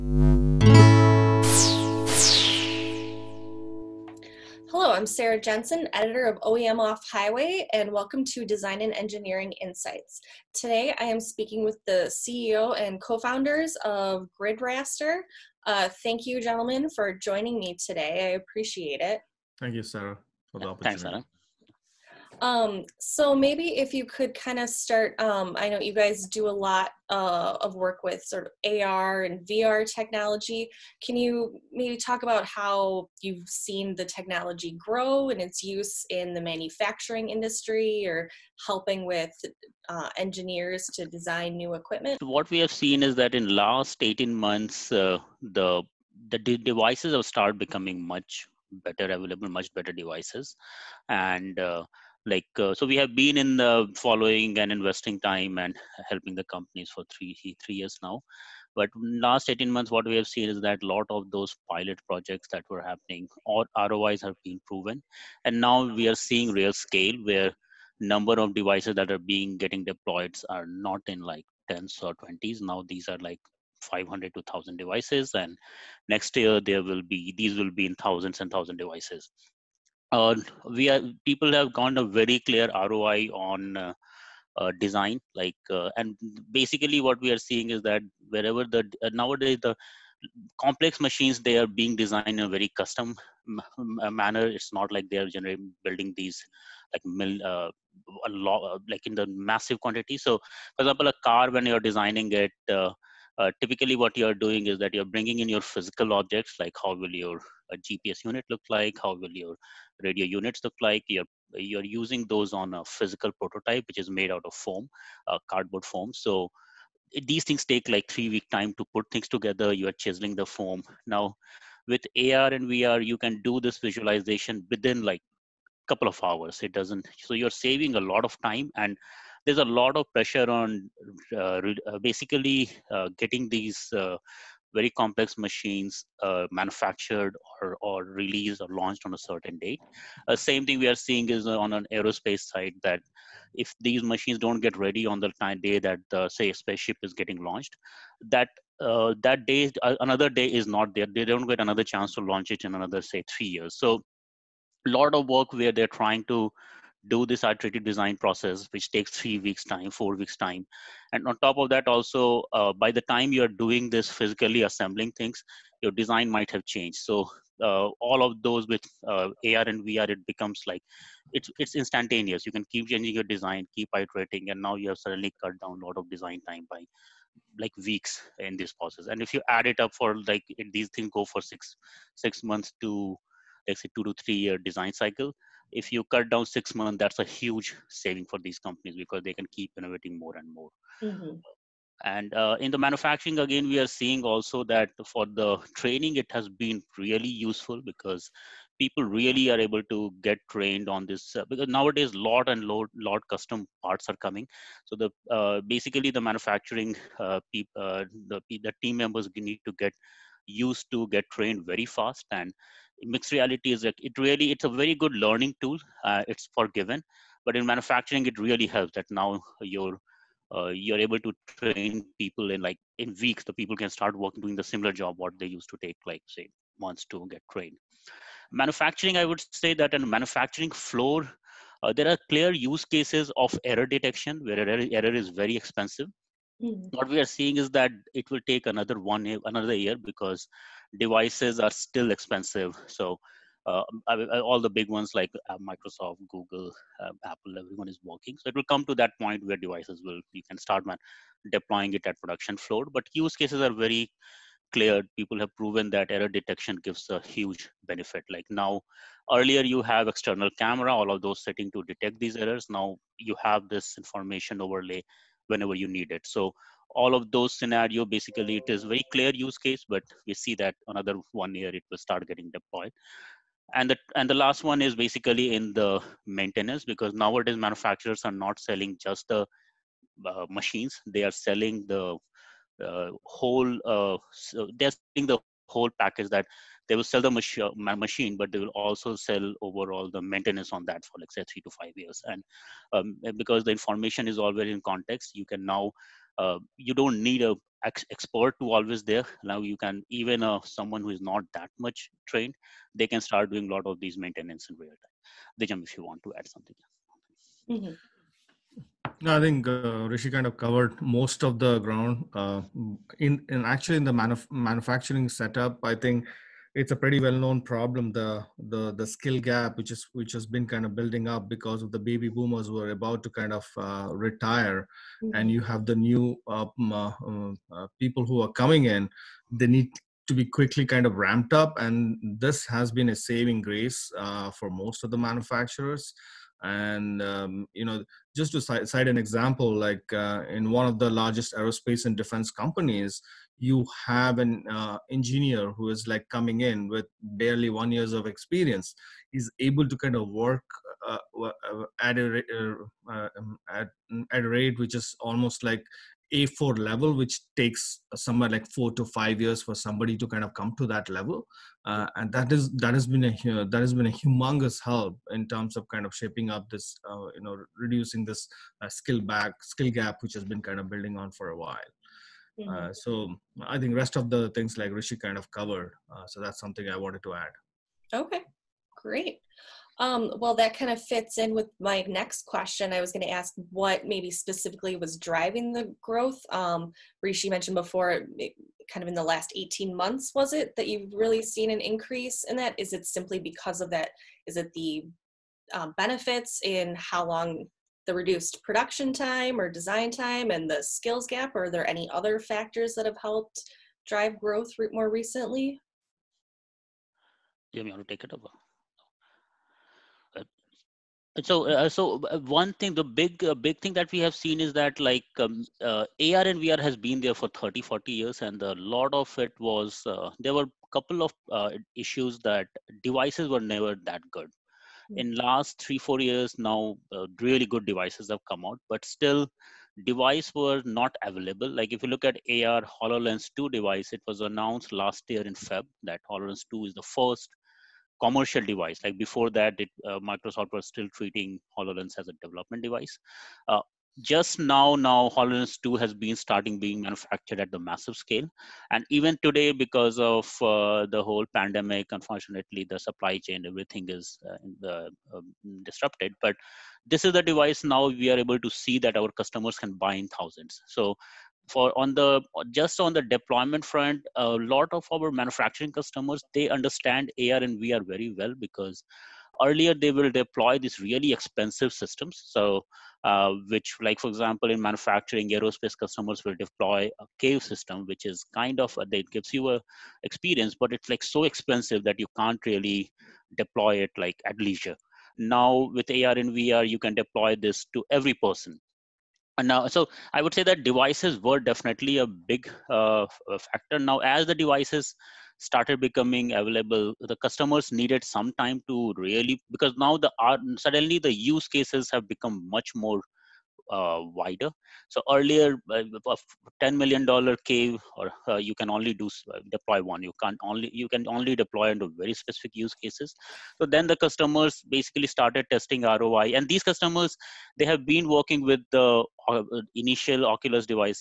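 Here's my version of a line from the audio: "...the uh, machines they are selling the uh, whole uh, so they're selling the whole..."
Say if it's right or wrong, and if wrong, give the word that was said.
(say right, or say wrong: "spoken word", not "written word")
right.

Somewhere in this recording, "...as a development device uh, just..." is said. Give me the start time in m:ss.
7:22.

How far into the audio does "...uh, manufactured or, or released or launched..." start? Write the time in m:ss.
2:16.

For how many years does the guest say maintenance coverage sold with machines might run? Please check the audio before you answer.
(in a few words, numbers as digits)
3 to 5 years.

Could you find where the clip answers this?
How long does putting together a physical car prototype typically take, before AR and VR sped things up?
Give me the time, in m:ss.
1:58.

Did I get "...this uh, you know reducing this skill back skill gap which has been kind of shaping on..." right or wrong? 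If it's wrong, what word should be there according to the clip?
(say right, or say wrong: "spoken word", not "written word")
wrong: "building", not "shaping".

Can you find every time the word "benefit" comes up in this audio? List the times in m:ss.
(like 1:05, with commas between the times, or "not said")
4:17, 6:35.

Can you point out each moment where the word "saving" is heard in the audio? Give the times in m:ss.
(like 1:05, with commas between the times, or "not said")
2:07, 3:07, 5:33.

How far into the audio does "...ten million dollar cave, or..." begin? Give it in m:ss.
8:26.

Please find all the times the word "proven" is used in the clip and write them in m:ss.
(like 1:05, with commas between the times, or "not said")
1:04, 4:15.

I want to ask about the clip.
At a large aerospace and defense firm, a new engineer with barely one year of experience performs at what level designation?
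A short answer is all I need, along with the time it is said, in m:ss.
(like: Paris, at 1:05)
A4, at 5:56.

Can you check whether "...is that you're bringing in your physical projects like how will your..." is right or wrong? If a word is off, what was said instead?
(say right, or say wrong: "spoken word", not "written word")
wrong: "objects", not "projects".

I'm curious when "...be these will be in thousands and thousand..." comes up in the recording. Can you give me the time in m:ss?
1:17.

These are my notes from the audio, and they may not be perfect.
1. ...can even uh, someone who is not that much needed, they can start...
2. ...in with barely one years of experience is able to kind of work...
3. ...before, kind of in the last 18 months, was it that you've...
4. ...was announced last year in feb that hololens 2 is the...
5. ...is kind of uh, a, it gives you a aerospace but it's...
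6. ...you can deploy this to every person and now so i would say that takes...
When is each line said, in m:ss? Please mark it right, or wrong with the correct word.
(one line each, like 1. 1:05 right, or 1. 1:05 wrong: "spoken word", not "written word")
1. 4:59 wrong: "trained", not "needed"
2. 5:46 right
3. 6:27 right
4. 7:14 right
5. 7:58 wrong: "experience", not "aerospace"
6. 8:06 wrong: "devices", not "takes".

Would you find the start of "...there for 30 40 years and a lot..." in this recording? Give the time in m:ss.
6:57.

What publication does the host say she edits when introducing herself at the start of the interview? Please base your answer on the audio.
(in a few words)
OEM Off Highway.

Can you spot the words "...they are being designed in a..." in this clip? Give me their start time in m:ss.
1:31.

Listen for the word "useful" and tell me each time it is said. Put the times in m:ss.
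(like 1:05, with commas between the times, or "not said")
3:17.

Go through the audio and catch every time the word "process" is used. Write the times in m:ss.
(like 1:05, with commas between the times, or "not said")
2:38, 2:58.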